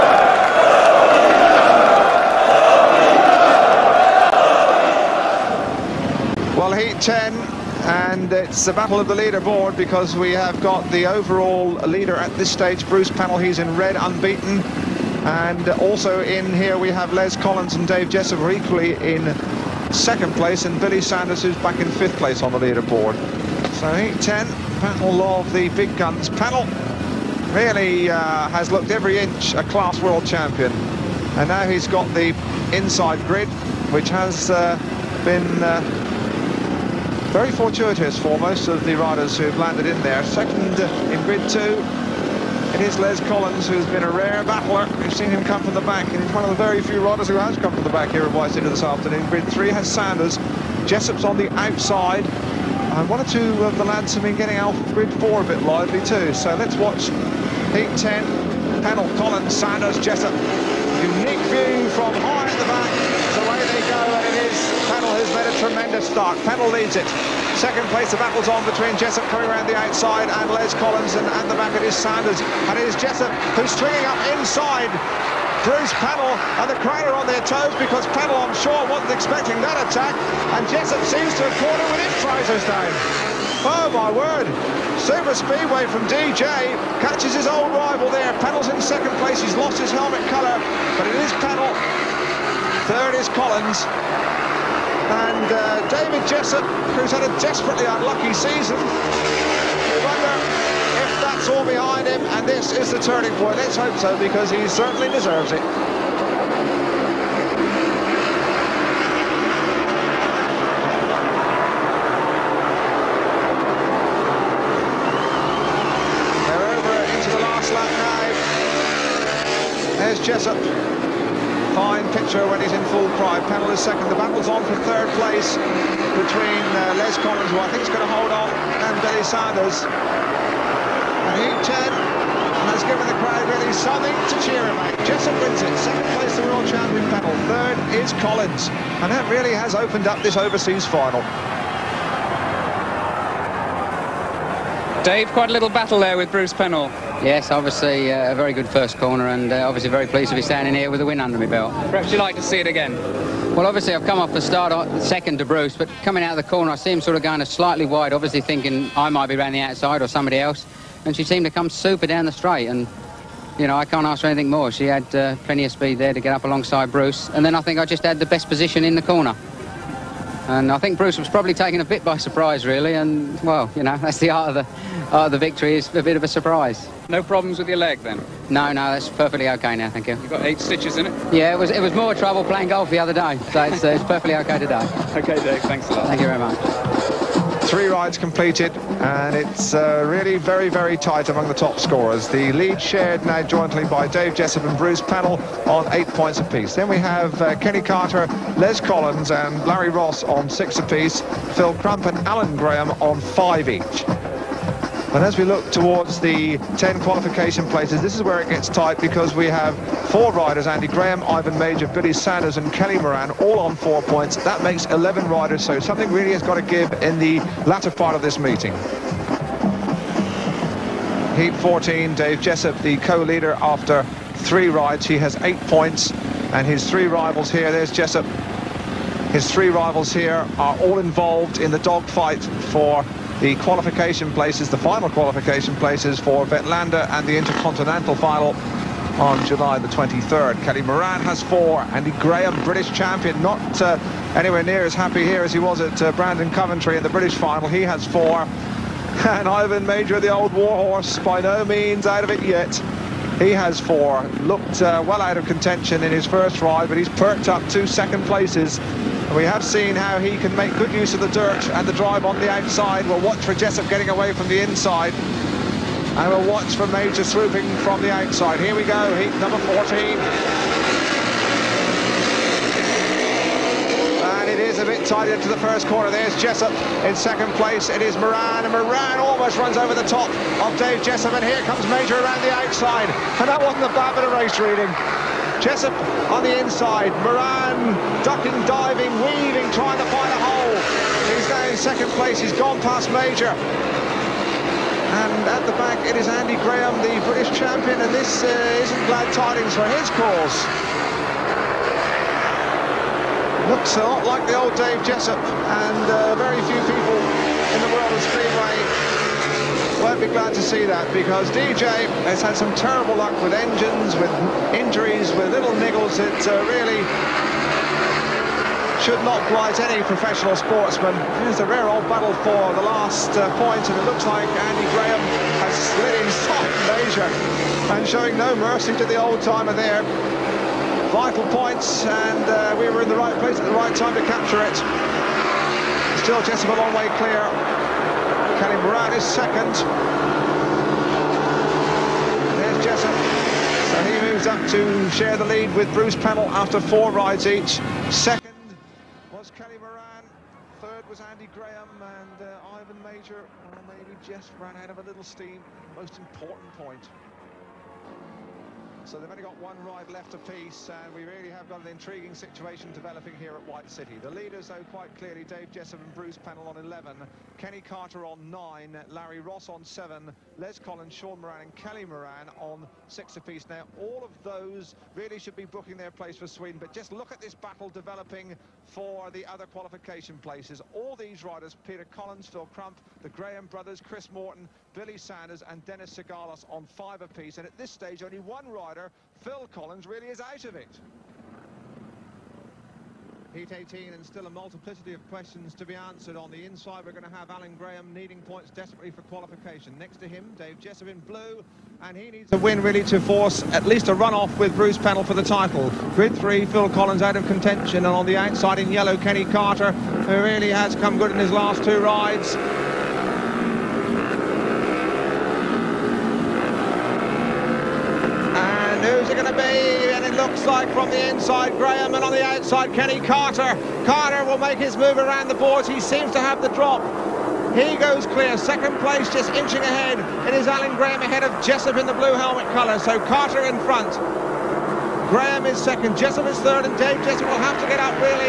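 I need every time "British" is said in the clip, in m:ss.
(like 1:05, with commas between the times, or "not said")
4:02, 4:07, 4:57.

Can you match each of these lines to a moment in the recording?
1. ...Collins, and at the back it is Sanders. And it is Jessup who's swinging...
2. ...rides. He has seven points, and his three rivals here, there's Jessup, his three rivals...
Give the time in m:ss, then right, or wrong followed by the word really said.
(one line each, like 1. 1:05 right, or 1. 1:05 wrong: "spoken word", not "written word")
1. 1:10 right
2. 3:44 wrong: "eight", not "seven".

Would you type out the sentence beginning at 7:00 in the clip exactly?
looks like from the inside, Grahame, and on the outside, Kenny Carter.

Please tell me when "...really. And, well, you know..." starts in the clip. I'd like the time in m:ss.
2:52.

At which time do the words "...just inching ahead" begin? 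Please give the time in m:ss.
7:09.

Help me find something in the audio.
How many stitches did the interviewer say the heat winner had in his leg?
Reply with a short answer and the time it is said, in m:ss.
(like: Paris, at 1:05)
8, at 3:00.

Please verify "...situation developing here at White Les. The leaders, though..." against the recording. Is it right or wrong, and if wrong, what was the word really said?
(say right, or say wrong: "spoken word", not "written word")
wrong: "City", not "Les".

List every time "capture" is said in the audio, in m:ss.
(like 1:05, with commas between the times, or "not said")
5:34.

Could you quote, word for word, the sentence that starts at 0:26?
Penhall really uh, has looked every inch a class world champion.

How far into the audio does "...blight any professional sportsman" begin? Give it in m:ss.
5:19.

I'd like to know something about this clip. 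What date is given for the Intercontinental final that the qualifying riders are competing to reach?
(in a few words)
July 23.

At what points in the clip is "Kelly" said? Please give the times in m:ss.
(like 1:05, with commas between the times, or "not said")
3:32, 4:00, 5:38, 5:49, 6:11.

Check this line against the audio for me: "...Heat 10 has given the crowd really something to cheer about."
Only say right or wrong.
right.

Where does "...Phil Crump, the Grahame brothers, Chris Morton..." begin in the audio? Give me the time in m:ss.
6:22.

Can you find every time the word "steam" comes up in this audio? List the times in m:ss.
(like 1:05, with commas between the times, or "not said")
5:55.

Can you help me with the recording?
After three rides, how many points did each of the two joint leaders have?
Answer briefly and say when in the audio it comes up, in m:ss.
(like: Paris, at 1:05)
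8, at 3:15.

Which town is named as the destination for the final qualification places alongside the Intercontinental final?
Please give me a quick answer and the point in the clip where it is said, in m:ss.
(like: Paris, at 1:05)
Vetlanda, at 3:56.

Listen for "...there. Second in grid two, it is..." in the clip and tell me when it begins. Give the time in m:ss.
0:40.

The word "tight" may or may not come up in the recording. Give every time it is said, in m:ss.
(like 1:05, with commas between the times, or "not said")
3:10, 3:28, 4:35.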